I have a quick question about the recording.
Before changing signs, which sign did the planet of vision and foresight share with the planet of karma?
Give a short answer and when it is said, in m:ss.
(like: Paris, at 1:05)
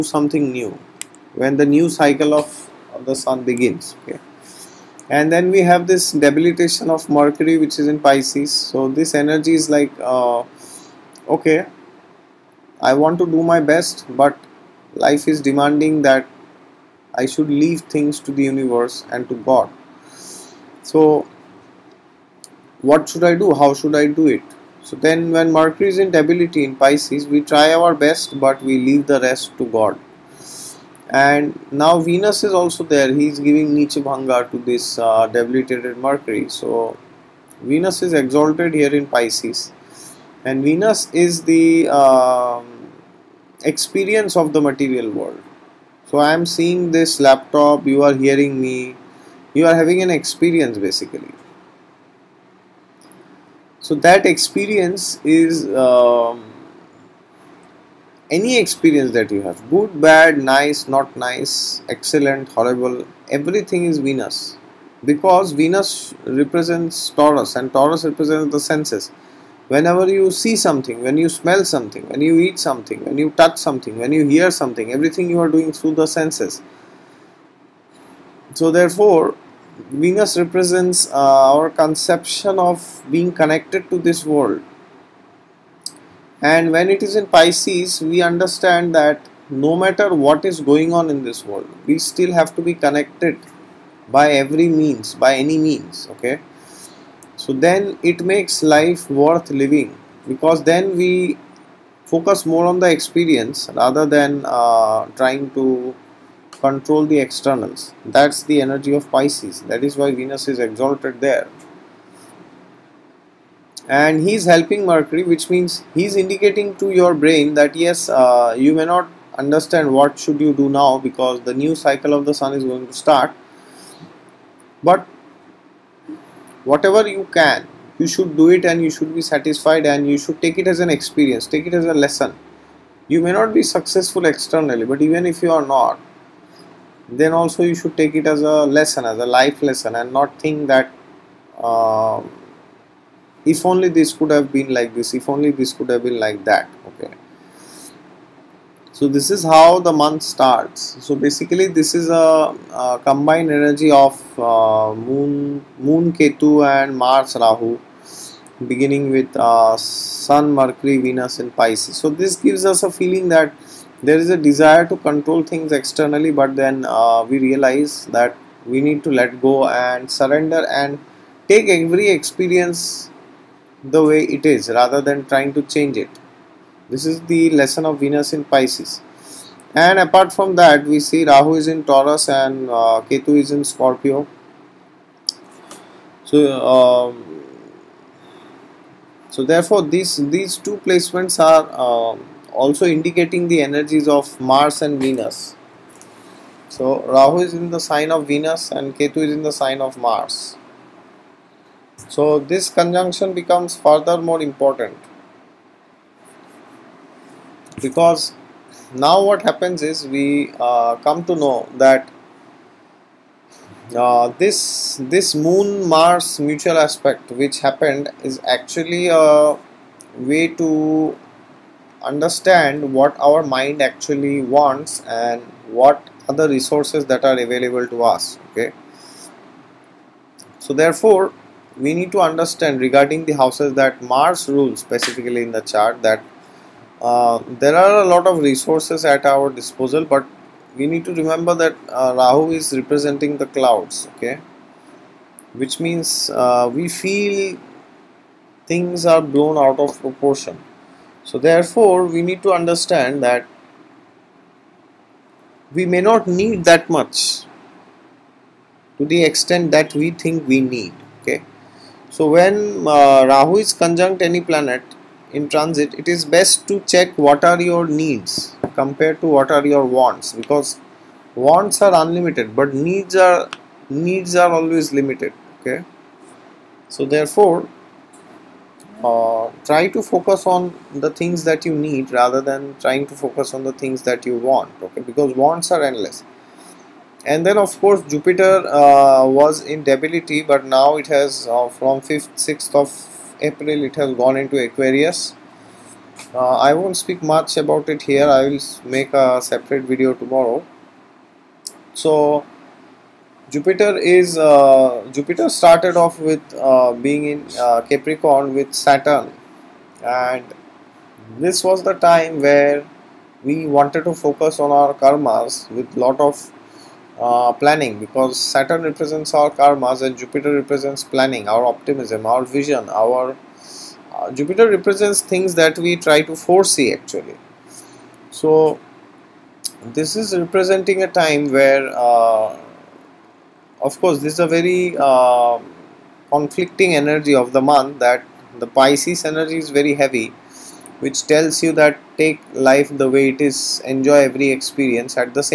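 Capricorn, at 5:07.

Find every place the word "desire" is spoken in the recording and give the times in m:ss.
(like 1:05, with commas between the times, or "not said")
2:44.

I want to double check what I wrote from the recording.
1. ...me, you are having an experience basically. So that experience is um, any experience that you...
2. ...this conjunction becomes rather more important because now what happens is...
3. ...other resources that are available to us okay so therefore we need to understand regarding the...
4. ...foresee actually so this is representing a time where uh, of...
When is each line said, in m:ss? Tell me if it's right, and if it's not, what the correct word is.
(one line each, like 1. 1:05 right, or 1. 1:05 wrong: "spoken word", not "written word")
1. 0:48 right
2. 3:22 wrong: "further", not "rather"
3. 3:46 right
4. 5:26 right.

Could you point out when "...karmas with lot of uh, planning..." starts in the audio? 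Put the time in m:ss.
5:14.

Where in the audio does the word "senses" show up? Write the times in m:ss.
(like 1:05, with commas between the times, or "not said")
1:08, 1:16.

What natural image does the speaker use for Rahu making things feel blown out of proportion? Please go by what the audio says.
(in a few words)
The clouds.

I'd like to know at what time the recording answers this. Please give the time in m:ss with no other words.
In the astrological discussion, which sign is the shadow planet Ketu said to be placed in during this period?
3:03.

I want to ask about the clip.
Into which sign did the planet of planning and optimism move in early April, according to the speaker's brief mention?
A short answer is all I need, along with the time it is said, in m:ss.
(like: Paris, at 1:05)
Aquarius, at 4:54.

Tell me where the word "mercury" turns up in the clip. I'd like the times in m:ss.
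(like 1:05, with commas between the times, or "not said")
0:07, 0:25, 0:35, 1:54, 2:40.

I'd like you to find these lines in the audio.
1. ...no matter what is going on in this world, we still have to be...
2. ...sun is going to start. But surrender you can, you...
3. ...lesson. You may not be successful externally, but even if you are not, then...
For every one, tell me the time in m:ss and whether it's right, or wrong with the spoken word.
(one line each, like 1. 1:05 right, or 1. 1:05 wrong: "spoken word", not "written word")
1. 1:29 right
2. 2:02 wrong: "whatever", not "surrender"
3. 2:11 right.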